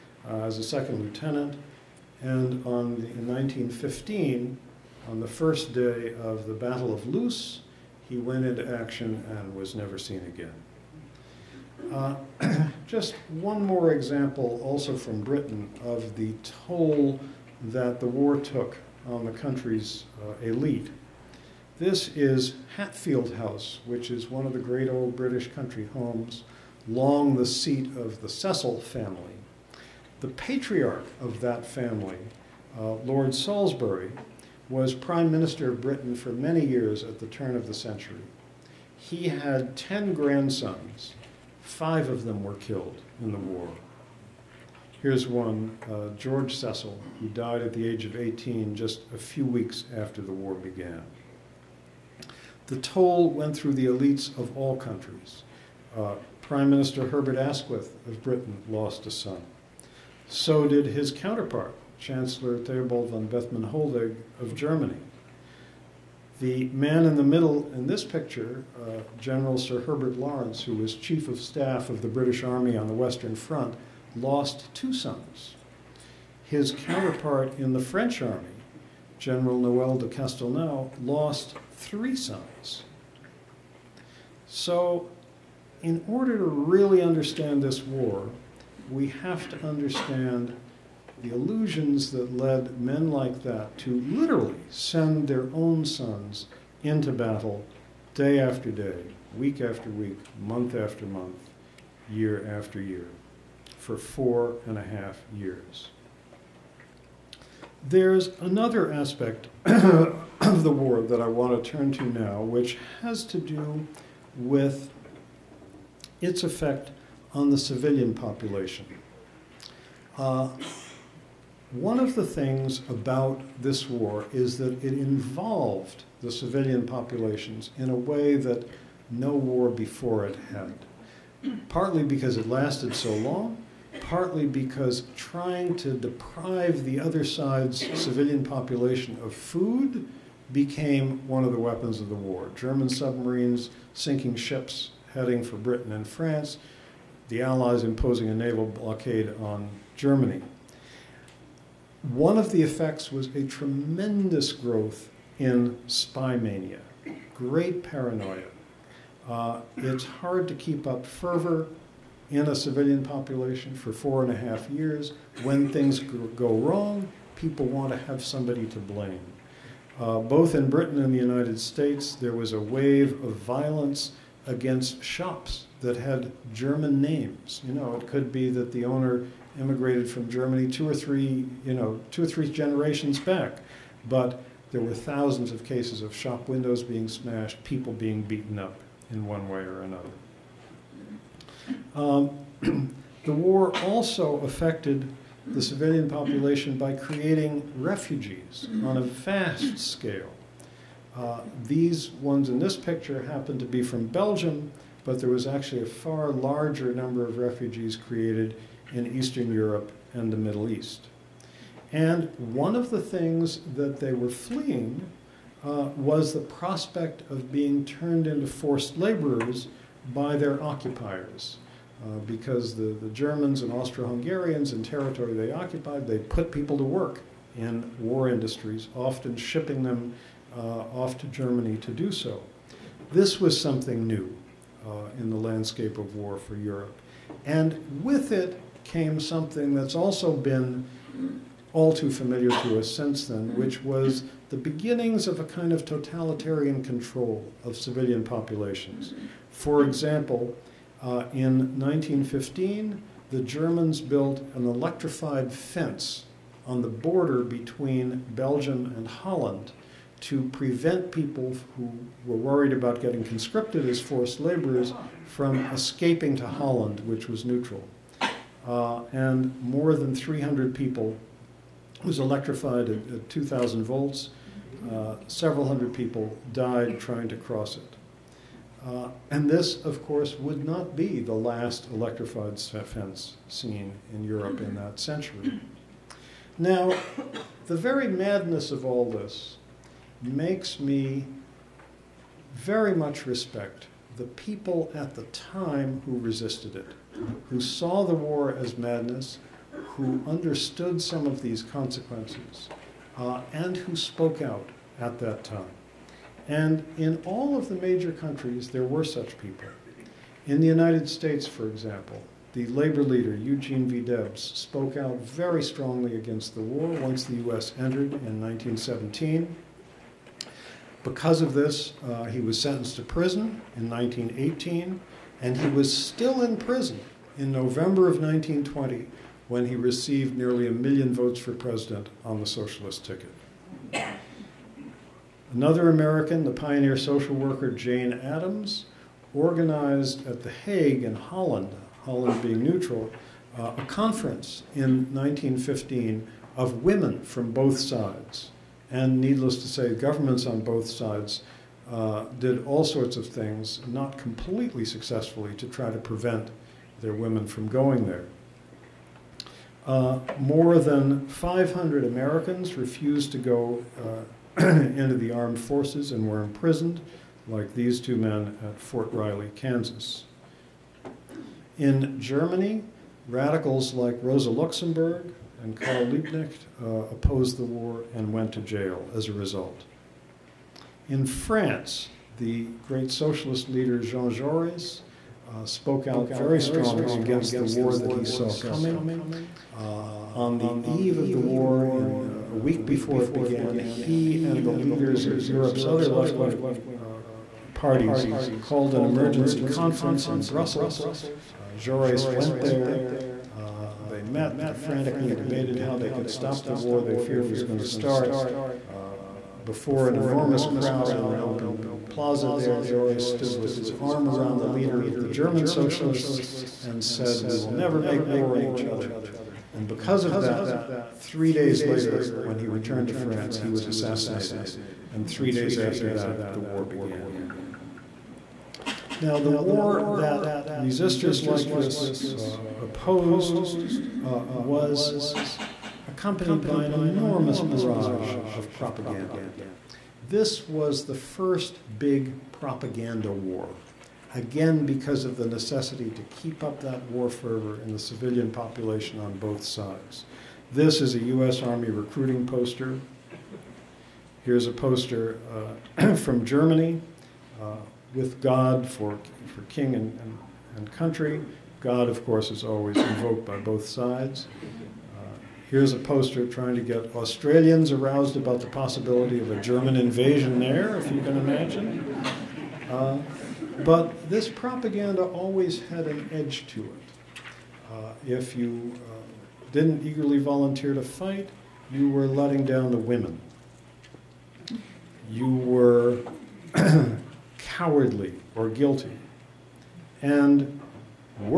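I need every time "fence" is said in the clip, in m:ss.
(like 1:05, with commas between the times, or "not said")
4:15, 4:42.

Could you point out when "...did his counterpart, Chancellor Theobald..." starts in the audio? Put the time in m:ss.
1:00.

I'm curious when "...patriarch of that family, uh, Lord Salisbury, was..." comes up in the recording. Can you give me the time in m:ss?
0:30.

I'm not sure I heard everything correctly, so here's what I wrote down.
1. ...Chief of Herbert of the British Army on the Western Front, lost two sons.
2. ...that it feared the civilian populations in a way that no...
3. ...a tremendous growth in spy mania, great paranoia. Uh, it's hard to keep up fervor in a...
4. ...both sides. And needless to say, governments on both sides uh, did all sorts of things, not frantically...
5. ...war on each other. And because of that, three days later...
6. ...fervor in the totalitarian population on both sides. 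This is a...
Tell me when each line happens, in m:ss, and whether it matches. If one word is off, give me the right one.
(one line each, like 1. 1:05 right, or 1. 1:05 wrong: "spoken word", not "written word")
1. 1:10 wrong: "Staff", not "Herbert"
2. 2:04 wrong: "involved", not "feared"
3. 2:33 right
4. 5:47 wrong: "completely", not "frantically"
5. 6:58 right
6. 7:27 wrong: "civilian", not "totalitarian".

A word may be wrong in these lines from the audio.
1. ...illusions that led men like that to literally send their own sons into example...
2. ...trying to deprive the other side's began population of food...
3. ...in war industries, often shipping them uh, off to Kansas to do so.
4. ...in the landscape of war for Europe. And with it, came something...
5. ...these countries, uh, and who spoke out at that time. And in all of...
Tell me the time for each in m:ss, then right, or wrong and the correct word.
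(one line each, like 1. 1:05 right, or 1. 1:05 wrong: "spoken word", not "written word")
1. 1:31 wrong: "battle", not "example"
2. 2:15 wrong: "civilian", not "began"
3. 3:47 wrong: "Germany", not "Kansas"
4. 3:55 right
5. 5:01 wrong: "consequences", not "countries".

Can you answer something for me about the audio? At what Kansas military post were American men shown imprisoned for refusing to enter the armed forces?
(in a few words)
Fort Riley.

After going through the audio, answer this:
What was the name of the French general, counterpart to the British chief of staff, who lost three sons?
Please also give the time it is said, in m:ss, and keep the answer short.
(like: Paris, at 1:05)
Noel de Castelnau, at 1:19.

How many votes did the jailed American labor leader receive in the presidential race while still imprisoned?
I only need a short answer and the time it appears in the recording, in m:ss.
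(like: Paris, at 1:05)
nearly a million, at 5:30.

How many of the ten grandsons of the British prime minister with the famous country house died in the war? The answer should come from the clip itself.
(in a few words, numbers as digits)
5.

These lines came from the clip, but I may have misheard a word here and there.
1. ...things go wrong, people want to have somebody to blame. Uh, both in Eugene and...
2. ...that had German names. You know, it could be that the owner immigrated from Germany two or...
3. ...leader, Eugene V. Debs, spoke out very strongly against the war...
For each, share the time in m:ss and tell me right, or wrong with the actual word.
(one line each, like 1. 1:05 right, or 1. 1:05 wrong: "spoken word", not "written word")
1. 2:45 wrong: "Britain", not "Eugene"
2. 2:55 right
3. 5:13 right.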